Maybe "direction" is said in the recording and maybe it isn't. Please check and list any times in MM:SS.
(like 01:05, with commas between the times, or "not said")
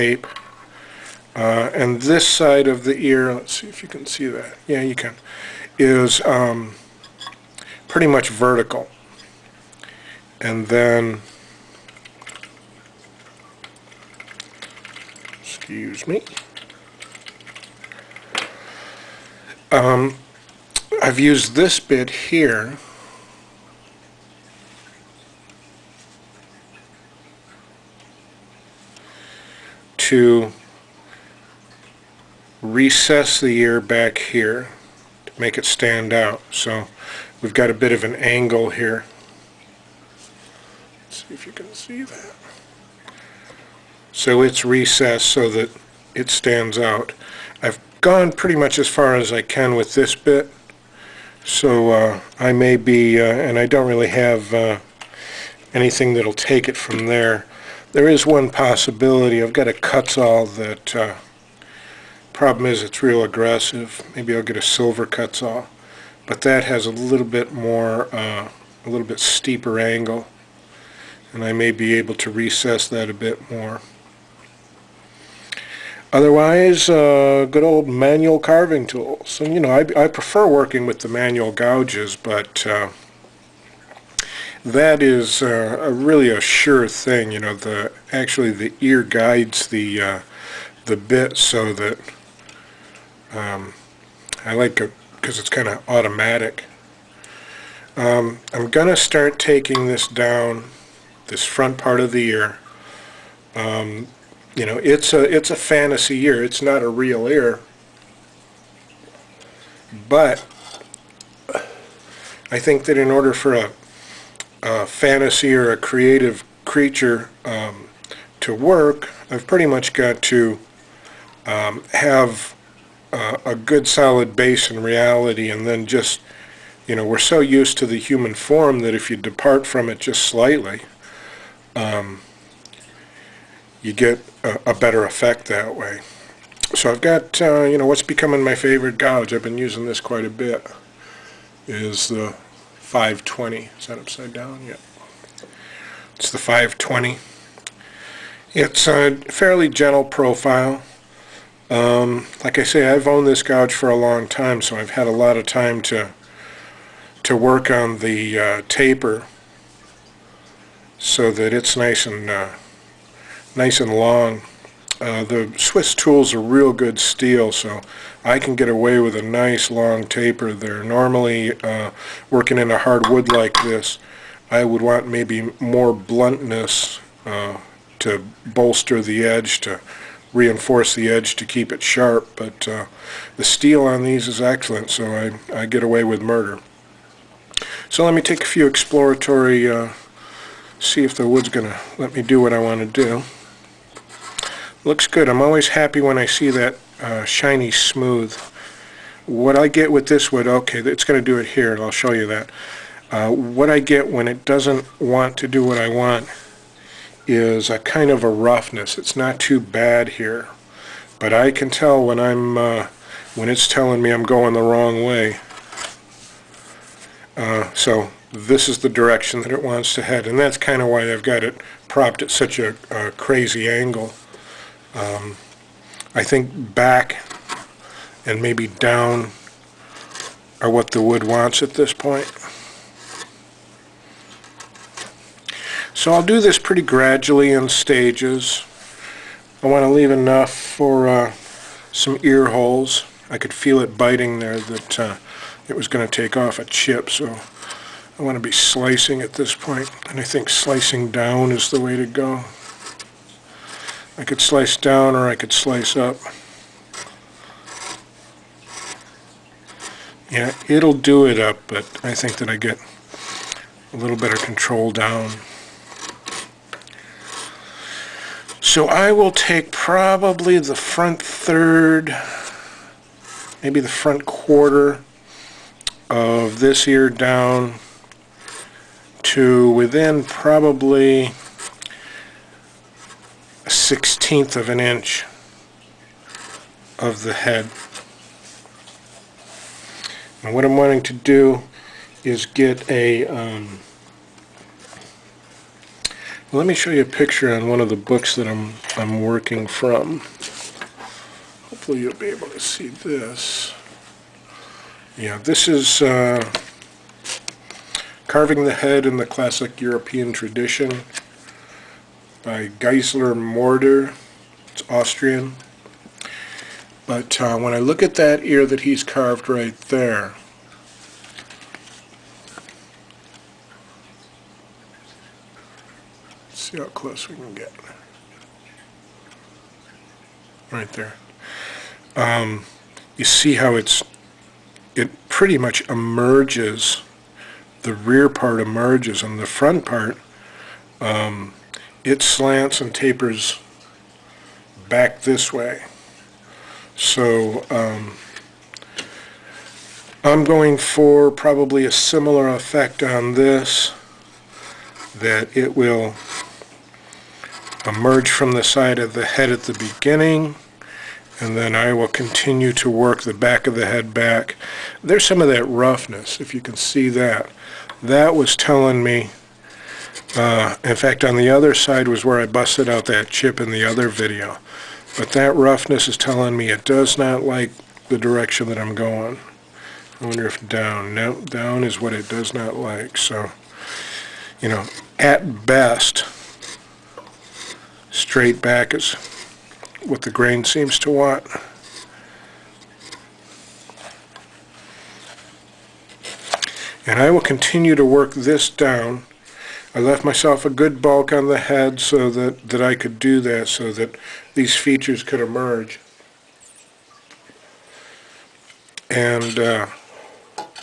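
03:38, 06:18.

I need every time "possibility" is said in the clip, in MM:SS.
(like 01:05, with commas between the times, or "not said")
00:58.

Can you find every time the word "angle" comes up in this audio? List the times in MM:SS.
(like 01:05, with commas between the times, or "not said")
00:38, 01:09, 03:43.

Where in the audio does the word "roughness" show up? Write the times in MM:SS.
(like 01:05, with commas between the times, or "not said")
03:28, 06:05, 06:15.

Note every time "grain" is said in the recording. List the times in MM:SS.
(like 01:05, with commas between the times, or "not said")
06:30.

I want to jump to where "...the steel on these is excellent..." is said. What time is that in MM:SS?
03:03.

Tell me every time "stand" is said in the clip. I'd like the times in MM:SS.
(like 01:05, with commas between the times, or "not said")
00:35, 00:46.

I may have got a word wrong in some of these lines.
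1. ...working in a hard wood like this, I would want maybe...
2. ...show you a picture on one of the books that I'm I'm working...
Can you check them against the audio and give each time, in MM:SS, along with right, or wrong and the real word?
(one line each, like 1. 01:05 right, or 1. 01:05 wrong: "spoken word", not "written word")
1. 02:52 right
2. 04:56 right.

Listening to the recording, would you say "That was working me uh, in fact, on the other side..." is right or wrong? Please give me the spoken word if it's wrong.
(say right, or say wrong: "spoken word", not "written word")
wrong: "telling", not "working".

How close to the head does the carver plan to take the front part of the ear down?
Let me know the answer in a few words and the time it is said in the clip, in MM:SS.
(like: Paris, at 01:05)
1/16 inch, at 04:43.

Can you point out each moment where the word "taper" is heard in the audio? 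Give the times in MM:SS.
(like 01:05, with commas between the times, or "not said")
02:38, 02:50, 05:42.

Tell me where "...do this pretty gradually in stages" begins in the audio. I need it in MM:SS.
03:56.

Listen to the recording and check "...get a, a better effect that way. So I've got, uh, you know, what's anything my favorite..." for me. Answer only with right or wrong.
wrong.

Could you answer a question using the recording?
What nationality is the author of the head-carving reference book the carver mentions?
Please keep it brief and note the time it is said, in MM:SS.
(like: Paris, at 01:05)
Austrian, at 05:14.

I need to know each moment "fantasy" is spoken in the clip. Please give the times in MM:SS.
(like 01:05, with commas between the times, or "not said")
01:45, 01:54.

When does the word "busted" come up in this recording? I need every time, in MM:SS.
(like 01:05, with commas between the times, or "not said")
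06:12.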